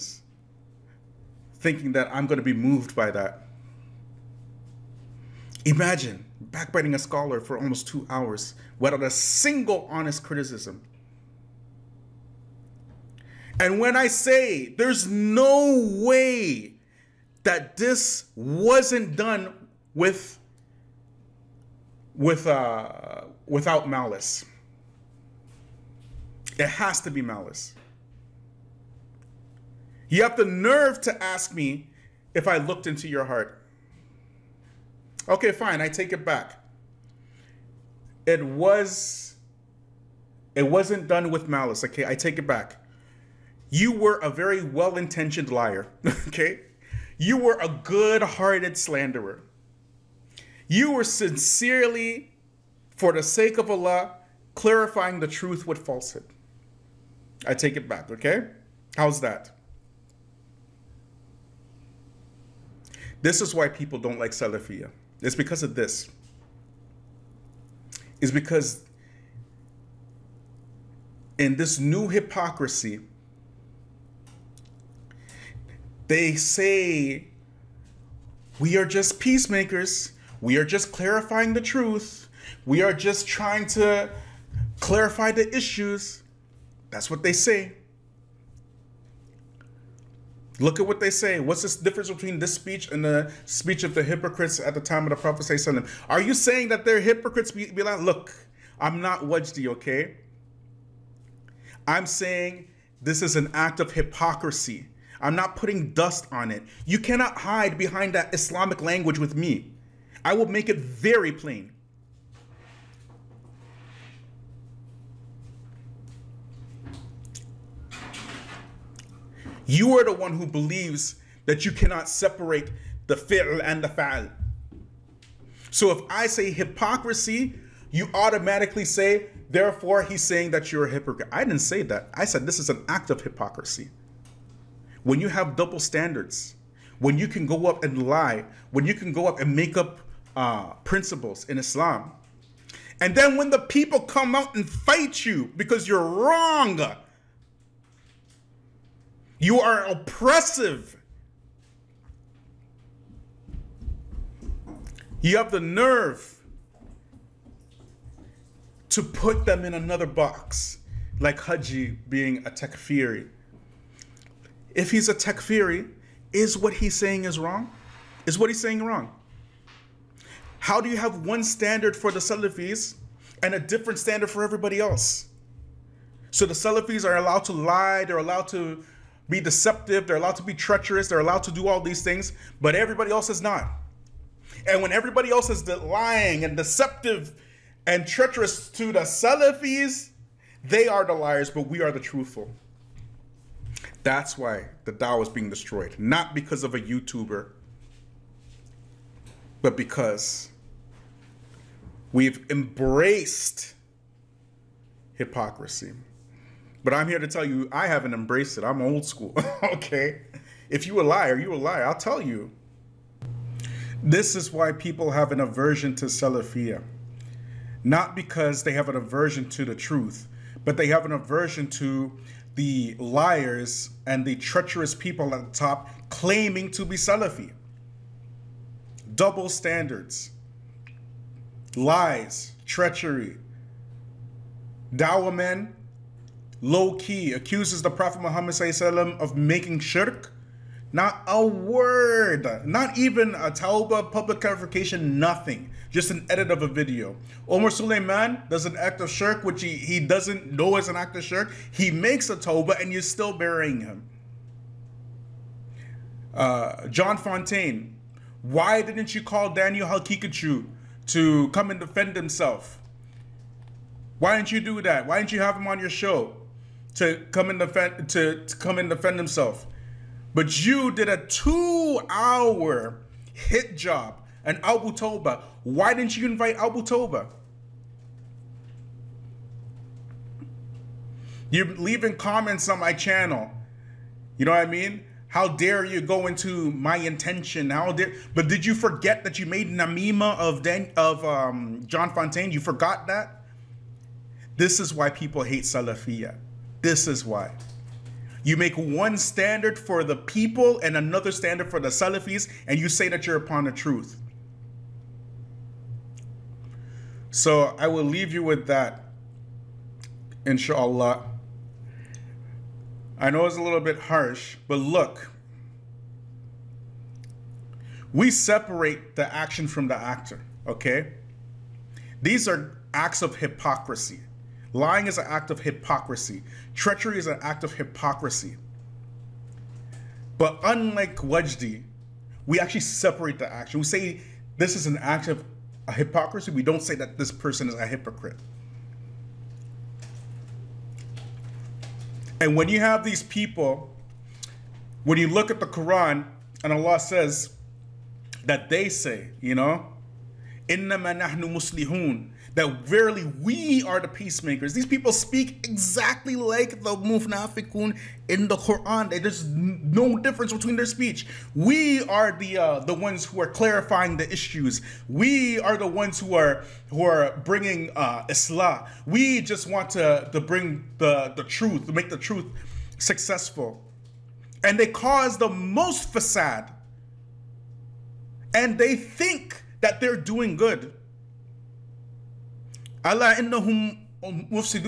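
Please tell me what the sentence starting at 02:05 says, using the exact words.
So if I say hypocrisy, you automatically say, therefore he's saying that you're a hypocrite.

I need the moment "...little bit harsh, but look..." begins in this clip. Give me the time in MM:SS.
05:13.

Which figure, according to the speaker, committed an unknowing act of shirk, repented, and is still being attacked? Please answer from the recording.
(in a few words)
Omar Suleiman.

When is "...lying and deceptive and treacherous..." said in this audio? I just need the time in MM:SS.
03:05.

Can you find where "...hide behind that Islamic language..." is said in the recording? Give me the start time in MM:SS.
01:47.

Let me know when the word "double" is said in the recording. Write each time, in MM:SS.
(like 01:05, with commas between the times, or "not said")
02:15, 03:49.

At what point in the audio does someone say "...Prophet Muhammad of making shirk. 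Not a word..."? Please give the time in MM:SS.
03:57.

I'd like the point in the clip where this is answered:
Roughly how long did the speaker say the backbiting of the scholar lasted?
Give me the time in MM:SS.
00:07.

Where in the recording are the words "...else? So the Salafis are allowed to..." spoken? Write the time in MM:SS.
02:54.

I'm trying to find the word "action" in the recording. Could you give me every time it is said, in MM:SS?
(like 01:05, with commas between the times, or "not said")
05:19, 05:33.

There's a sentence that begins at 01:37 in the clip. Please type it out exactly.
Be, be like, look, I'm not Wajdi, okay?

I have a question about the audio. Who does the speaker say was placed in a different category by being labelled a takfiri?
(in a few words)
Haji.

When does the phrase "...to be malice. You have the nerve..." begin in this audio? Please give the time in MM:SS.
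00:27.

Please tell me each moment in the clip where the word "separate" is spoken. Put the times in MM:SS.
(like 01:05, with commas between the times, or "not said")
02:02, 05:18, 05:32.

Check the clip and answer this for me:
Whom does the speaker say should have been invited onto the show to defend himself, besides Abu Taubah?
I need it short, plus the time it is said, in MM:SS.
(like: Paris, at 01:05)
Daniel Haqiqatjou, at 04:19.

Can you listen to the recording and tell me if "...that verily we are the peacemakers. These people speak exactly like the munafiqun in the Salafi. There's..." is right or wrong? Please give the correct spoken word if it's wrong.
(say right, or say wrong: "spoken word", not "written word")
wrong: "Quran", not "Salafi".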